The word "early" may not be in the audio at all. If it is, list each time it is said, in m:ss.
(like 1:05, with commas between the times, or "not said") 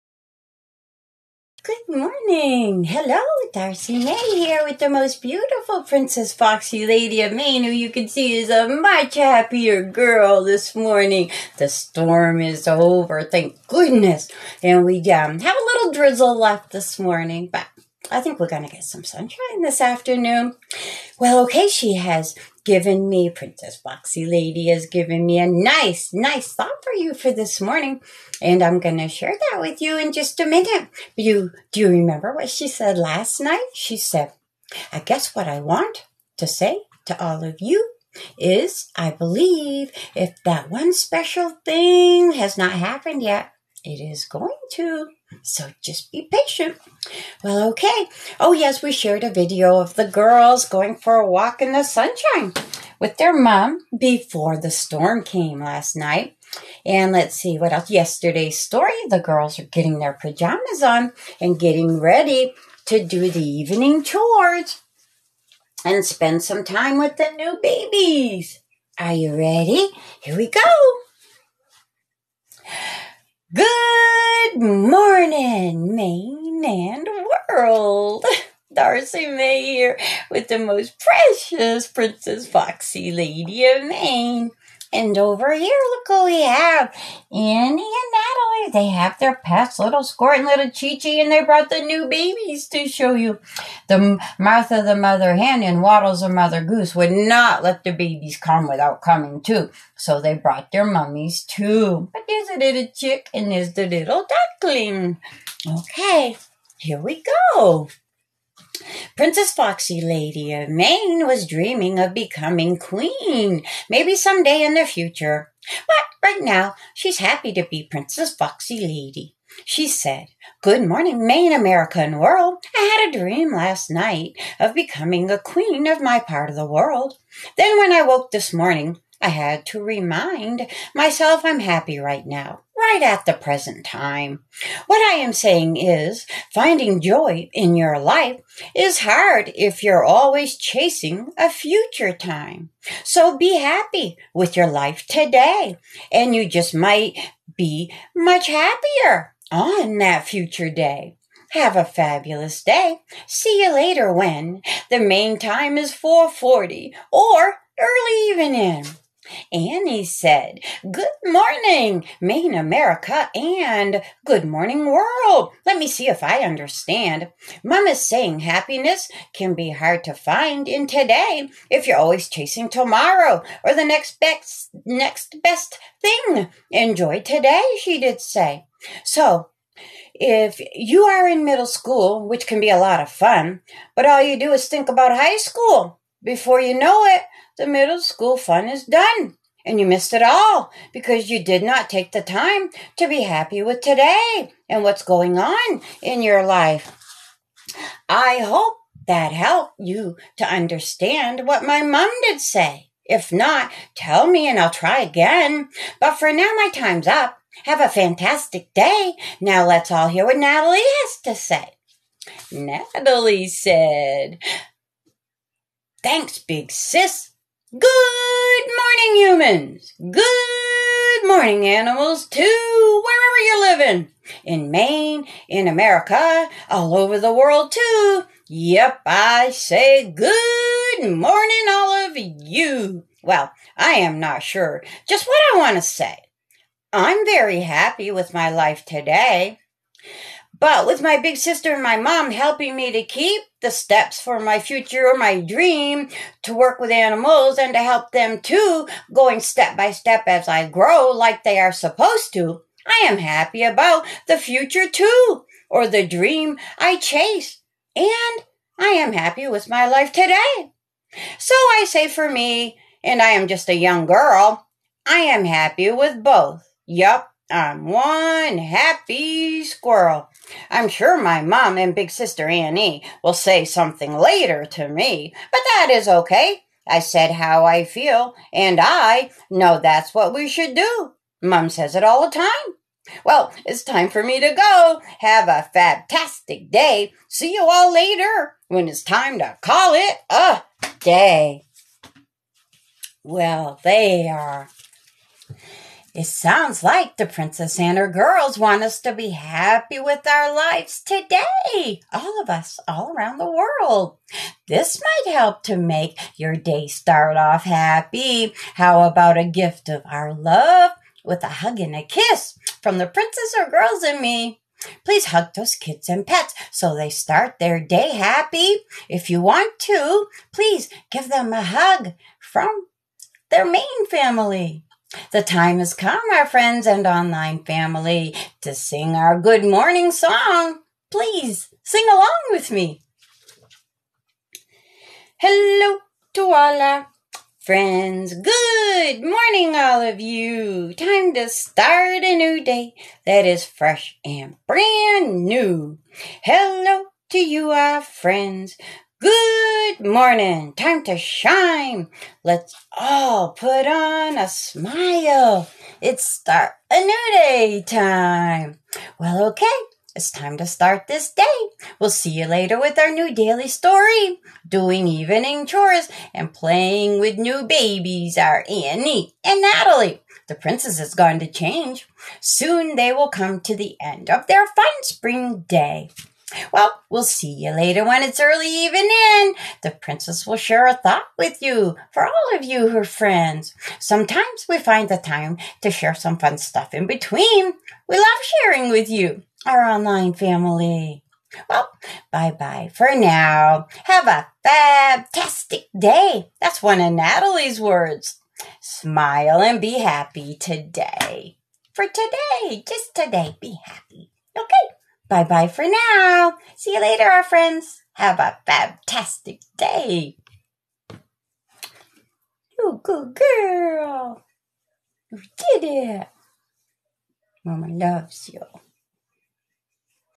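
2:37, 6:18.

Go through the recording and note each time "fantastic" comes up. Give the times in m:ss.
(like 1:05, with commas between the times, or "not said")
3:27, 4:45, 6:34, 6:48.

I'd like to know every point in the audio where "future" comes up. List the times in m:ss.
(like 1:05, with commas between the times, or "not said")
1:54, 2:21, 2:30, 4:04, 4:14.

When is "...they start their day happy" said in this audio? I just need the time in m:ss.
5:16.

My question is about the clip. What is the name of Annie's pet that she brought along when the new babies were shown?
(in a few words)
Squirt.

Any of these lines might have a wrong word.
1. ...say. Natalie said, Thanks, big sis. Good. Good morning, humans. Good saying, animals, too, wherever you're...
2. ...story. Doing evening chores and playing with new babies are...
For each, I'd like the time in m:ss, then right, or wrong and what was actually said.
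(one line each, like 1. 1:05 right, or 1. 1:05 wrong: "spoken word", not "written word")
1. 3:31 wrong: "morning", not "saying"
2. 6:03 right.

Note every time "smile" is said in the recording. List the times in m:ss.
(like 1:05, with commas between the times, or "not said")
5:54, 6:38.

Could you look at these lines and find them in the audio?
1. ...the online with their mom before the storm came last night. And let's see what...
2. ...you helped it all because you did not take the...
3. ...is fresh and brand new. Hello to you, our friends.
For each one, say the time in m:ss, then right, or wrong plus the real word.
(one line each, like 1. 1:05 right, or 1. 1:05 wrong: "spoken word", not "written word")
1. 0:51 wrong: "sunshine", not "online"
2. 3:09 wrong: "missed", not "helped"
3. 5:43 right.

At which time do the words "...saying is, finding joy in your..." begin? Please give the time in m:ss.
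2:15.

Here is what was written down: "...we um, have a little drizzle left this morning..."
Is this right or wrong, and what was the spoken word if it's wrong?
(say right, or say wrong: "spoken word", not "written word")
right.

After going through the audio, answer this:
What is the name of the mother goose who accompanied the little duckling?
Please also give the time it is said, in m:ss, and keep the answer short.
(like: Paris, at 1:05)
Waddles, at 1:35.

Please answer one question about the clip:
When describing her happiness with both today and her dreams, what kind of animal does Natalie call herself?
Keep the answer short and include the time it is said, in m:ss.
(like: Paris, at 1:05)
Squirrel, at 4:27.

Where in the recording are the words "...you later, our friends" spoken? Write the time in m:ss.
6:46.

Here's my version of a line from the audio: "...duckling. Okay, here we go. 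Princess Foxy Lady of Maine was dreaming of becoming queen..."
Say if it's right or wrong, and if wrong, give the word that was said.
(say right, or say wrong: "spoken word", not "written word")
right.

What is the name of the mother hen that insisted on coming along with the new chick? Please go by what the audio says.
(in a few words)
Martha.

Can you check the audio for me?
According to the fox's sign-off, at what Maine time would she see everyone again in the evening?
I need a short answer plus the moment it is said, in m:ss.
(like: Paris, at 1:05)
4:40, at 2:35.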